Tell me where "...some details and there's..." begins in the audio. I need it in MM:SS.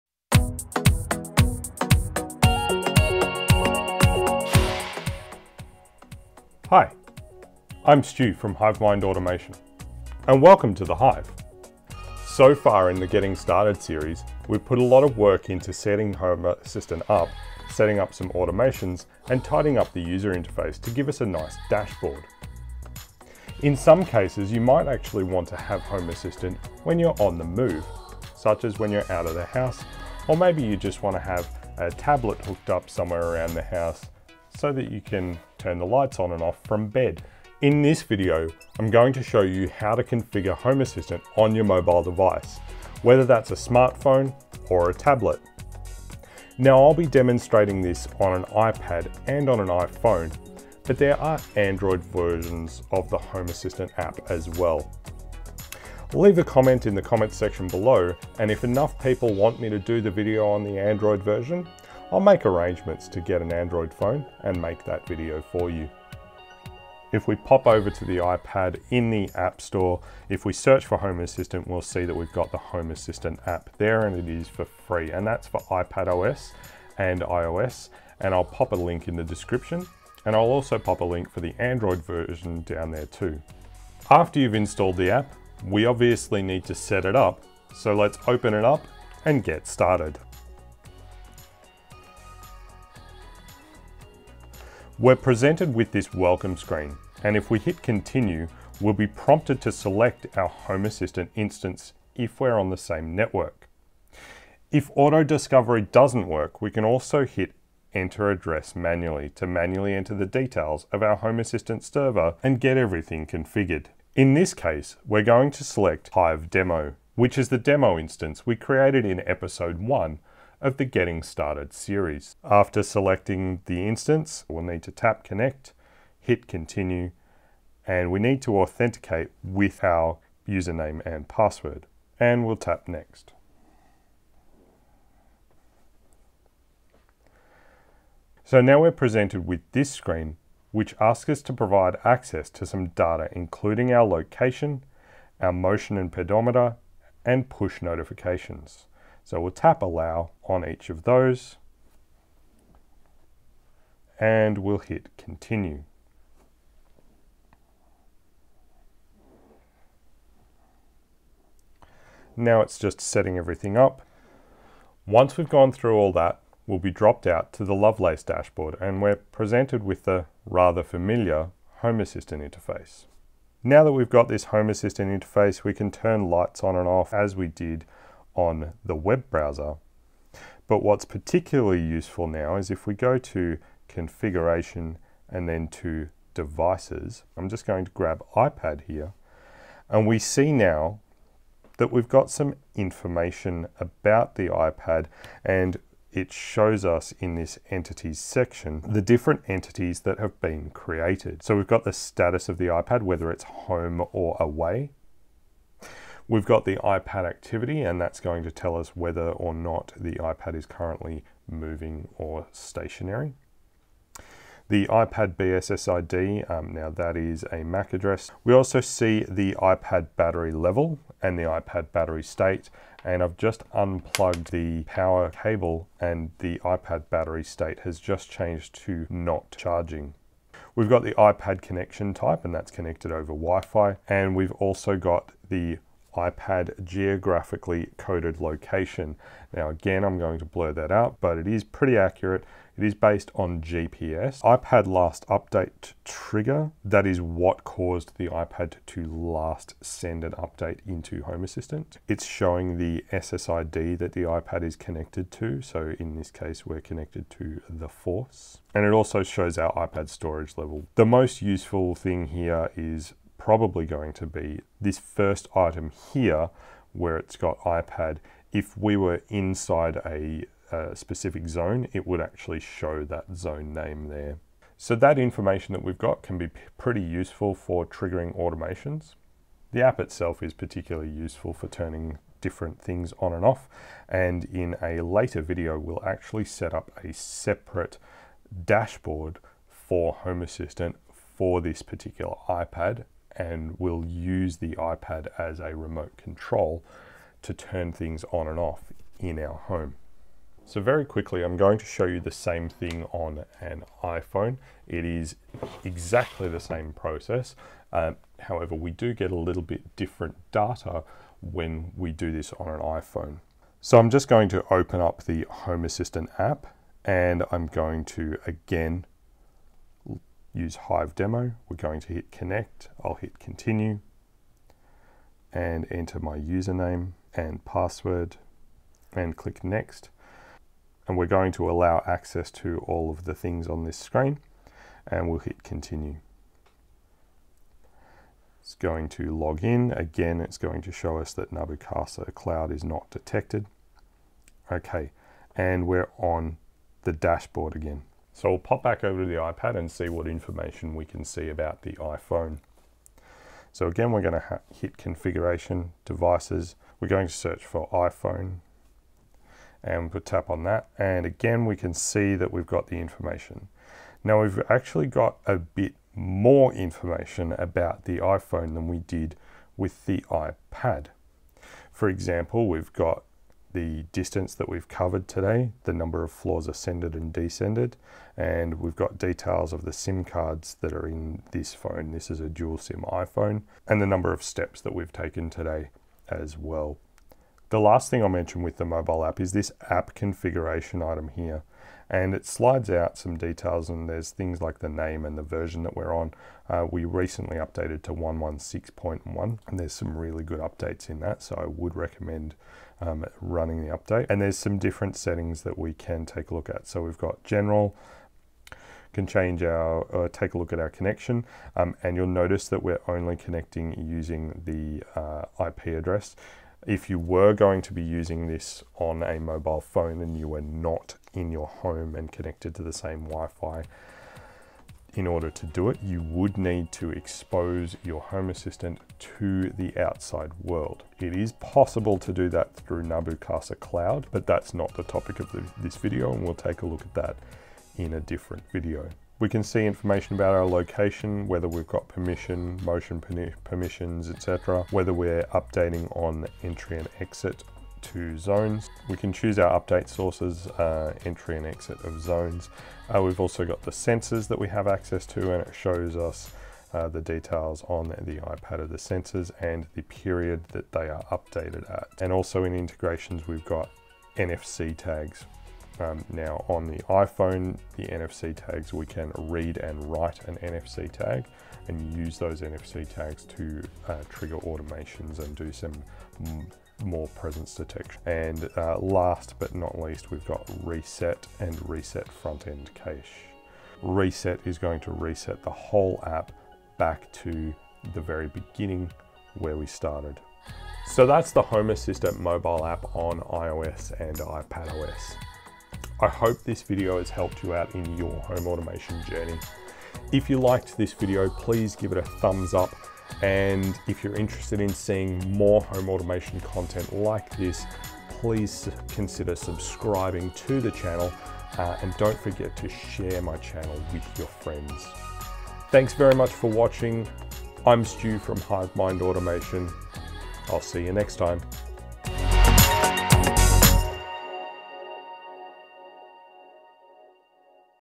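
06:33.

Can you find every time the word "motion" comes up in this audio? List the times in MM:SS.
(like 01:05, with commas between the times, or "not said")
02:25, 07:22.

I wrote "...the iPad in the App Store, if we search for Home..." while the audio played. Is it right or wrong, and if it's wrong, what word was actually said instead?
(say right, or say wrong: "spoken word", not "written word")
right.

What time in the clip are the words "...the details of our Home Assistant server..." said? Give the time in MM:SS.
01:50.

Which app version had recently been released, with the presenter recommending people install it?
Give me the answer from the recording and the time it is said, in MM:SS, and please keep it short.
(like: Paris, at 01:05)
116.1, at 06:38.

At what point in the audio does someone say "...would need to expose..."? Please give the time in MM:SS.
07:06.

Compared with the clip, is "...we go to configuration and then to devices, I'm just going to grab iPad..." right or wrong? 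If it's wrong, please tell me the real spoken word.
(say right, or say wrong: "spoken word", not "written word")
right.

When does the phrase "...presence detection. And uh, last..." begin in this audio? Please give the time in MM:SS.
07:57.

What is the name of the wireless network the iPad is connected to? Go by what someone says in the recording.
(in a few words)
the Force.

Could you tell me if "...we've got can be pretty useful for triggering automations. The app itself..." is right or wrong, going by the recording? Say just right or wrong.
right.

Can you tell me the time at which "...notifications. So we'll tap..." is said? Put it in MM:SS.
02:27.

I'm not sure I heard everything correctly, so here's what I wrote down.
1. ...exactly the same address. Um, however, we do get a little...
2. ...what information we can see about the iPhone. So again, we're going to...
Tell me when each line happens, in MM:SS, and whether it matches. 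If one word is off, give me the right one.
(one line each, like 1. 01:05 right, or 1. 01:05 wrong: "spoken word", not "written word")
1. 05:05 wrong: "process", not "address"
2. 05:50 right.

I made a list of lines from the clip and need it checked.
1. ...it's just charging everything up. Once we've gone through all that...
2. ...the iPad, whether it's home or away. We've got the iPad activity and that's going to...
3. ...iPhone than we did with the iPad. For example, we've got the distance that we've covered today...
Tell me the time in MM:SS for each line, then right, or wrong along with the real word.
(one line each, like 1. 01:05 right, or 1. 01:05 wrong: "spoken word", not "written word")
1. 02:42 wrong: "setting", not "charging"
2. 03:22 right
3. 06:08 right.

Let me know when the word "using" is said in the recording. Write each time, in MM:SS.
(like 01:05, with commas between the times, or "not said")
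06:53, 06:58.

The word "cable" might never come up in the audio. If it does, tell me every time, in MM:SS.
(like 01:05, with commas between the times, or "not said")
03:45.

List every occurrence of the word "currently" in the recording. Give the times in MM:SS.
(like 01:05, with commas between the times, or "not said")
03:30.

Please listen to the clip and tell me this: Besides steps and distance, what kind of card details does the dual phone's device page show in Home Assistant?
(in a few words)
SIM cards.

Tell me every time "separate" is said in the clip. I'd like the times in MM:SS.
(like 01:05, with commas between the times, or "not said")
04:47.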